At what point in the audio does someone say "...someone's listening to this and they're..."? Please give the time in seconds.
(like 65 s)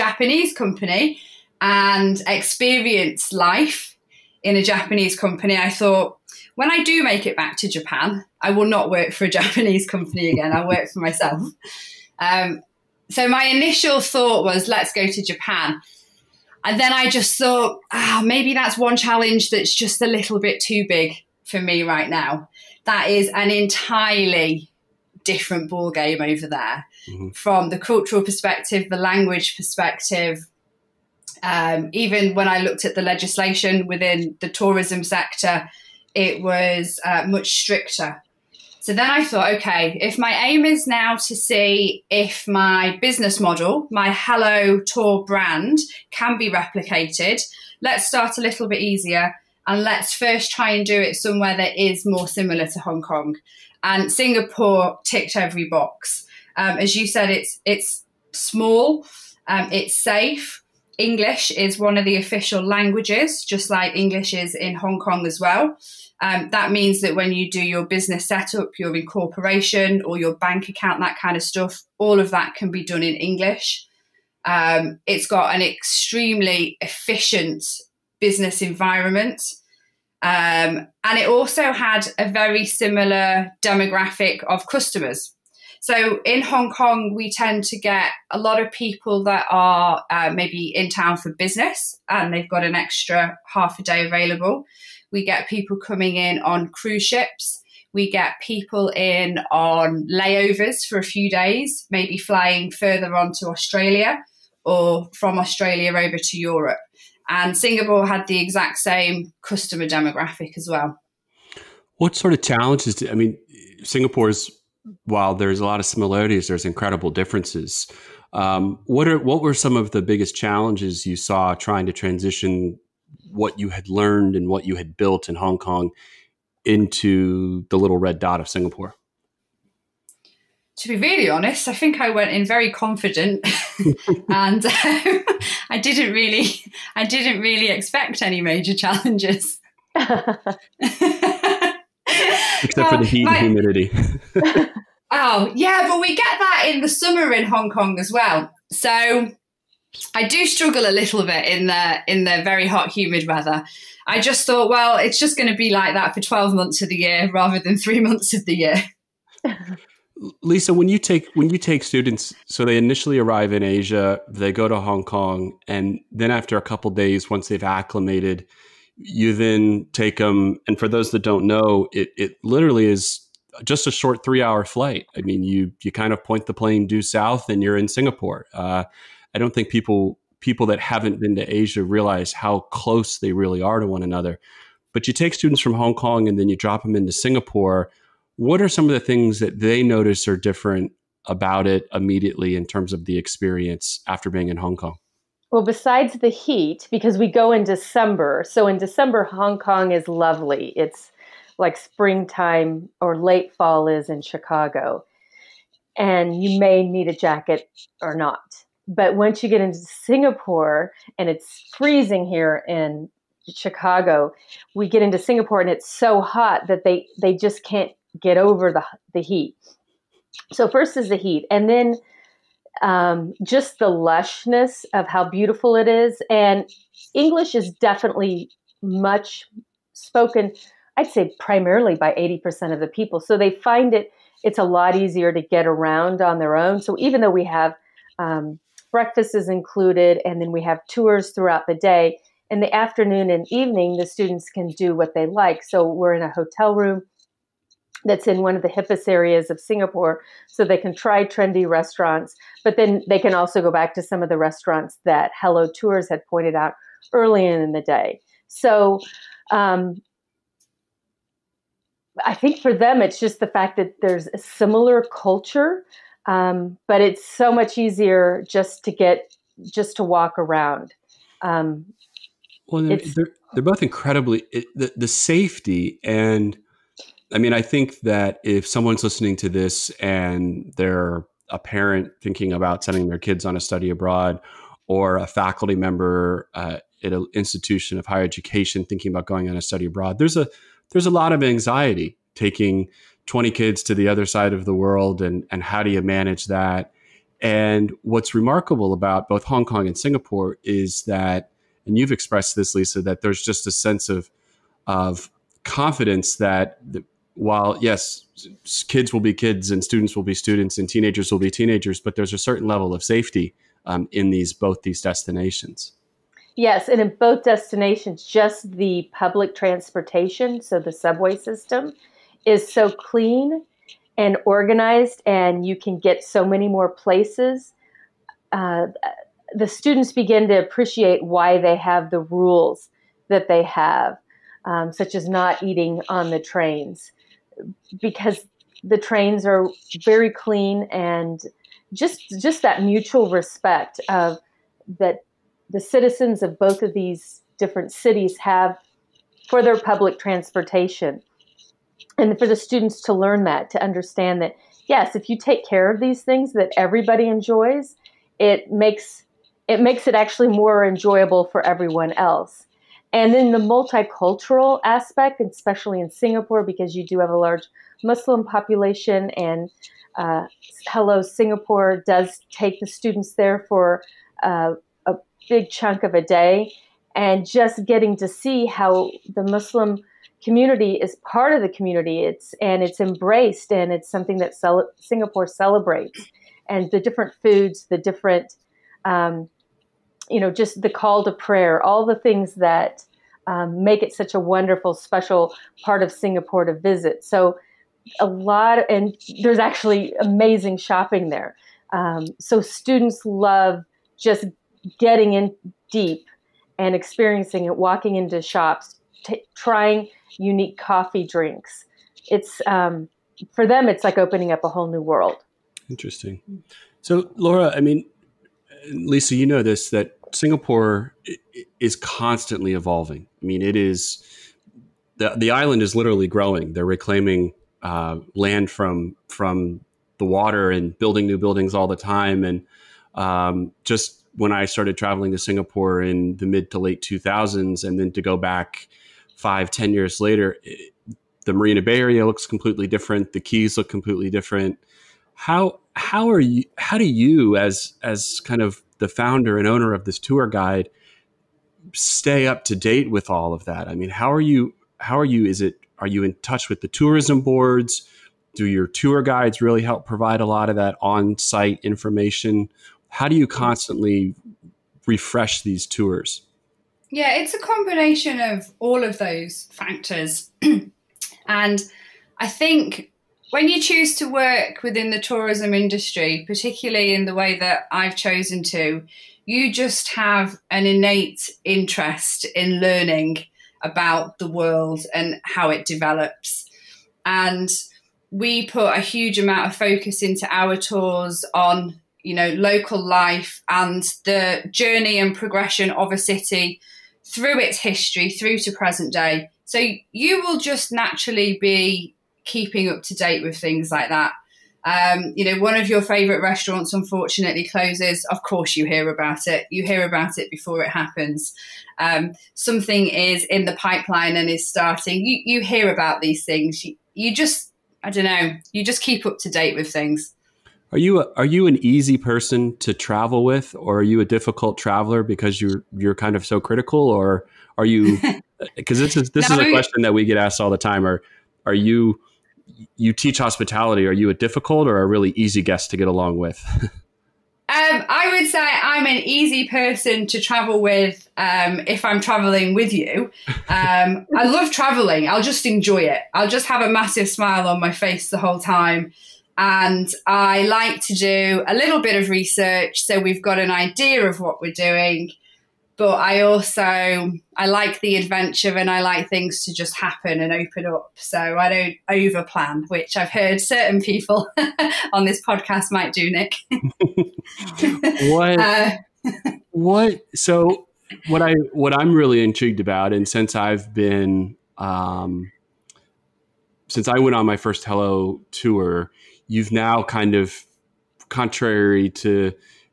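278 s.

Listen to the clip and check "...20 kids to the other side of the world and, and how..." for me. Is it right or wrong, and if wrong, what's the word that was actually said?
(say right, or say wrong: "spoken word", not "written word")
right.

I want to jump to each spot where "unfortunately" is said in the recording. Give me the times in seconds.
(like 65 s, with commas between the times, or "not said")
506 s.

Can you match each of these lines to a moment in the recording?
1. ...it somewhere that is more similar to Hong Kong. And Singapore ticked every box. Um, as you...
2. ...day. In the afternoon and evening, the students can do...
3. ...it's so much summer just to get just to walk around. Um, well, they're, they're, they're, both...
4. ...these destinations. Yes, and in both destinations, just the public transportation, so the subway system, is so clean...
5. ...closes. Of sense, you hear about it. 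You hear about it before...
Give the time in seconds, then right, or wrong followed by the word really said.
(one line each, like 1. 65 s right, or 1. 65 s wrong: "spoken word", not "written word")
1. 50 s right
2. 241 s right
3. 267 s wrong: "easier", not "summer"
4. 314 s right
5. 507 s wrong: "course", not "sense".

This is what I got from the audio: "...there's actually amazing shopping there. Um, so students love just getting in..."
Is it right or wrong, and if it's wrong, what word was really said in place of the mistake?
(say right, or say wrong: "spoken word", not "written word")
right.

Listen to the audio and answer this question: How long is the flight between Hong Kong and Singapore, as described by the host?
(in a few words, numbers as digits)
3 hours.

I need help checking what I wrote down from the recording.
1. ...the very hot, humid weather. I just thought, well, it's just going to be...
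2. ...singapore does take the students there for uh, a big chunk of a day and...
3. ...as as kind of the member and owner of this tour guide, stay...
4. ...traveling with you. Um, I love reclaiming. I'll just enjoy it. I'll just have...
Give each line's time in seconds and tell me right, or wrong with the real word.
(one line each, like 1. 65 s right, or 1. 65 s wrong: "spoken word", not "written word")
1. 152 s right
2. 371 s right
3. 447 s wrong: "founder", not "member"
4. 542 s wrong: "traveling", not "reclaiming".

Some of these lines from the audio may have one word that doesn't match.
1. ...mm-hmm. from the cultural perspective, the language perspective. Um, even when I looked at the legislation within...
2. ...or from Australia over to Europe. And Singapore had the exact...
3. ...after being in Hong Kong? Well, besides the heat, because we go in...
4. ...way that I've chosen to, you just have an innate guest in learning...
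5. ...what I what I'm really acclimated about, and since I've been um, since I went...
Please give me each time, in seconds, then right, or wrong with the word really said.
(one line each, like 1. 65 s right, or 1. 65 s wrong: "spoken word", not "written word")
1. 27 s right
2. 104 s right
3. 194 s right
4. 477 s wrong: "interest", not "guest"
5. 571 s wrong: "intrigued", not "acclimated".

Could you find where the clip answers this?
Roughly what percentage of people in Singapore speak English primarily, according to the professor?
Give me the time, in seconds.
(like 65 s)
232 s.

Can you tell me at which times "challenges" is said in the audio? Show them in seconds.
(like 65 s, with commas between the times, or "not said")
18 s, 112 s, 120 s, 138 s.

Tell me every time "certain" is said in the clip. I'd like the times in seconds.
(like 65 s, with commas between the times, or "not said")
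312 s, 563 s.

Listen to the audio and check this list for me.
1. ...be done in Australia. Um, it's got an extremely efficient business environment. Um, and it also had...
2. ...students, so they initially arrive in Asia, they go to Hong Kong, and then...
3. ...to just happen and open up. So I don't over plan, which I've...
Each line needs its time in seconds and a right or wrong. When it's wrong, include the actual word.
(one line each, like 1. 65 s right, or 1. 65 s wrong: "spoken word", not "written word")
1. 72 s wrong: "English", not "Australia"
2. 161 s right
3. 559 s right.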